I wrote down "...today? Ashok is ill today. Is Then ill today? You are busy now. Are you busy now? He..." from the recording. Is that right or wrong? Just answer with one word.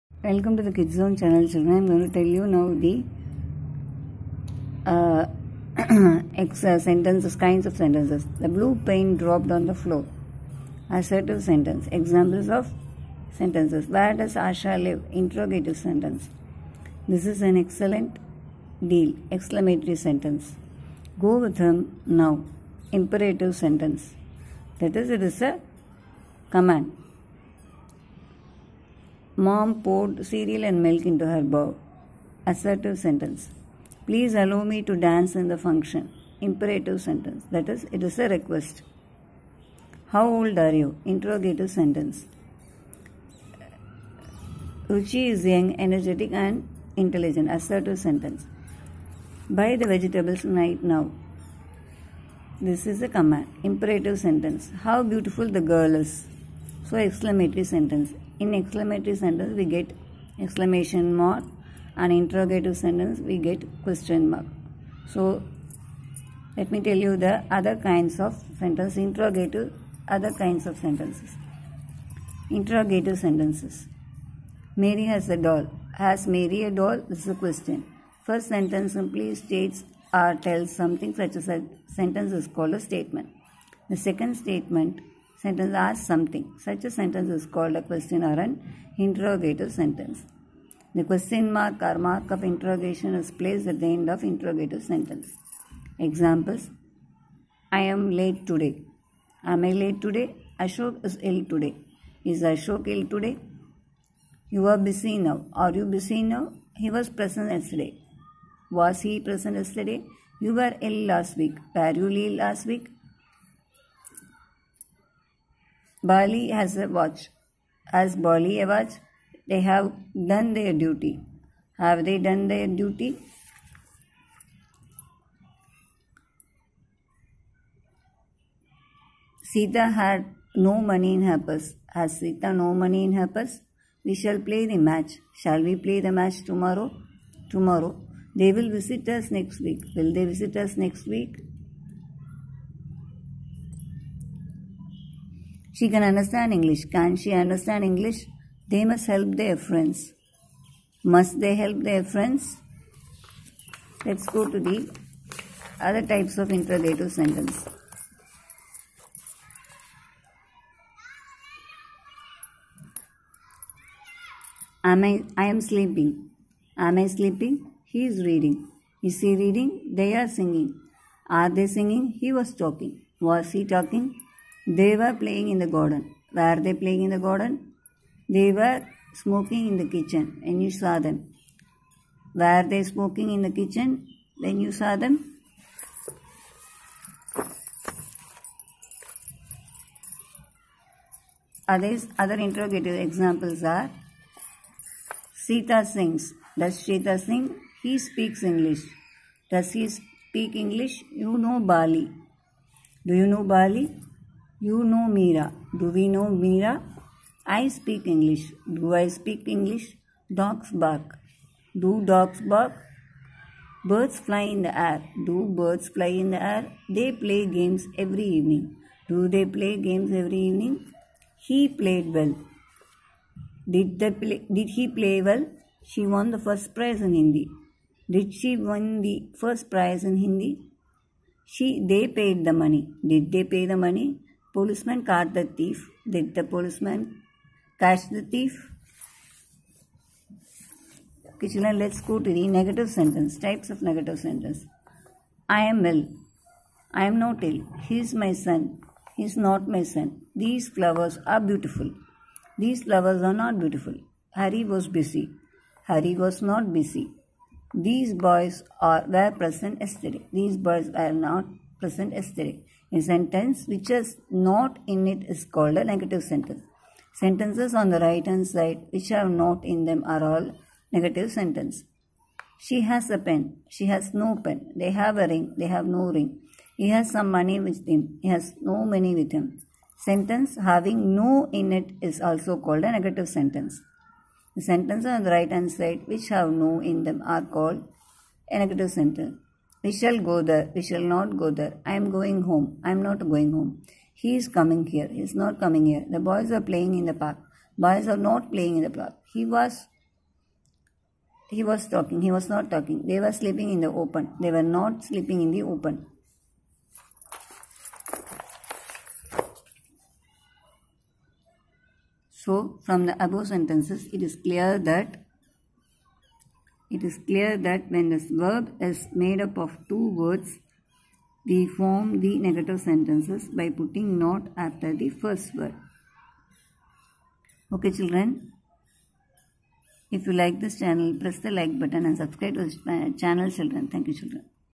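wrong.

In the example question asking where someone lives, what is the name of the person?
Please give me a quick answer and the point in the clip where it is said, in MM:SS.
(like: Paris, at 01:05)
Asha, at 00:14.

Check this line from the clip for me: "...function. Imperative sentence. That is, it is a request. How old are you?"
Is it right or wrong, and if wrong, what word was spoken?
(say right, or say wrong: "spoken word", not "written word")
right.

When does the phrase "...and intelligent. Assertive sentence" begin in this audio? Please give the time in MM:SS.
00:46.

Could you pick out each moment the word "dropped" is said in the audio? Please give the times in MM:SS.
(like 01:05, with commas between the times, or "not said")
00:09.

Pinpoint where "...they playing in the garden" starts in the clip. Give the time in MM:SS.
02:56.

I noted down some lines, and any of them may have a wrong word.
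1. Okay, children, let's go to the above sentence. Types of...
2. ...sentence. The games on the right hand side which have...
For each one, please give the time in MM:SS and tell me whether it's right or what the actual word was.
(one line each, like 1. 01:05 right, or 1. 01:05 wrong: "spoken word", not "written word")
1. 04:01 wrong: "negative", not "above"
2. 04:43 wrong: "sentences", not "games".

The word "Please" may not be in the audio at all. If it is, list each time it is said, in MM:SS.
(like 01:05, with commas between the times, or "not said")
00:34.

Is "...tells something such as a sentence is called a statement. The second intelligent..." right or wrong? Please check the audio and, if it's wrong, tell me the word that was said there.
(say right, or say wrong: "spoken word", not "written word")
wrong: "statement", not "intelligent".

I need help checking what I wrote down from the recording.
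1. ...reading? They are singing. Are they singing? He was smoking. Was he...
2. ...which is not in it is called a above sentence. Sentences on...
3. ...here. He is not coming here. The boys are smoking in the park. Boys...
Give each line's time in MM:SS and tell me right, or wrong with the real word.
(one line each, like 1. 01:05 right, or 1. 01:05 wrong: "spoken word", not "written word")
1. 02:49 wrong: "talking", not "smoking"
2. 04:23 wrong: "negative", not "above"
3. 04:54 wrong: "playing", not "smoking".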